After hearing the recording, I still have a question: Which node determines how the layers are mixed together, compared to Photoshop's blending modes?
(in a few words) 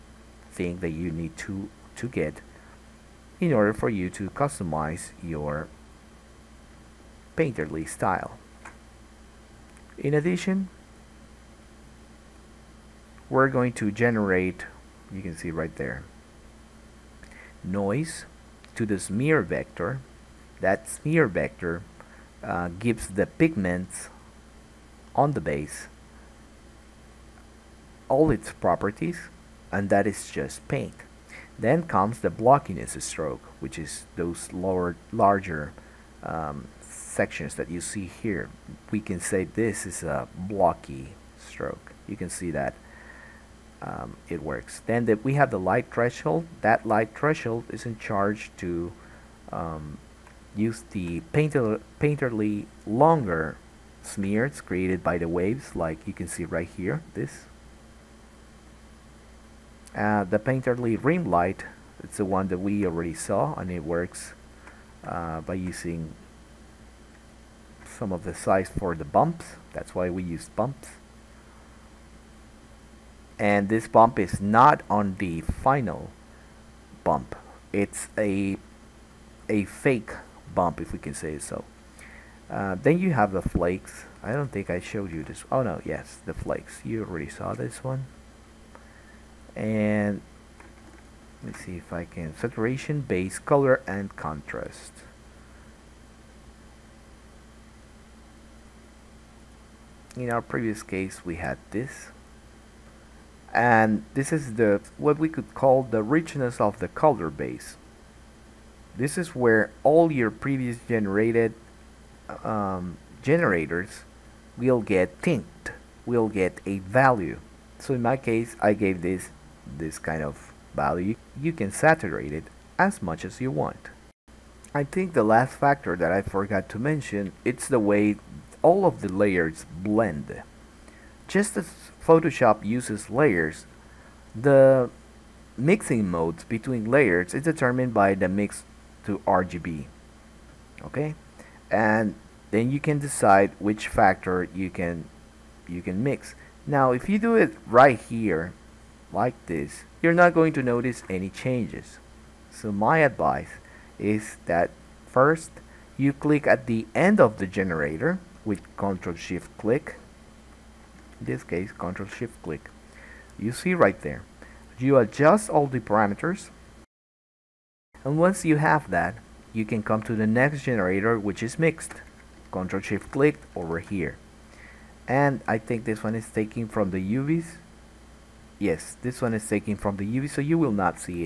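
Mix to RGB.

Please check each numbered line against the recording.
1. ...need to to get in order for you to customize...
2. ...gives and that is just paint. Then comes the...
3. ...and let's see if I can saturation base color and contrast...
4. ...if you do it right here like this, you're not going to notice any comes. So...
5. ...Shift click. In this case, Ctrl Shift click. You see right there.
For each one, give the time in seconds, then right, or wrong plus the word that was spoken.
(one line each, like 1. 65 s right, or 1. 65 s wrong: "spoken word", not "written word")
1. 1 s right
2. 28 s wrong: "properties", not "gives"
3. 89 s right
4. 146 s wrong: "changes", not "comes"
5. 159 s right.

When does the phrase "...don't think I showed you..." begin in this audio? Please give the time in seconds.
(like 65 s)
84 s.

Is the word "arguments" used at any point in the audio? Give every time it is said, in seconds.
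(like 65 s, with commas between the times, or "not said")
not said.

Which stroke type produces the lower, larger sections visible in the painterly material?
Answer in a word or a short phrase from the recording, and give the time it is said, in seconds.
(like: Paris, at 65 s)
Blocky stroke, at 40 s.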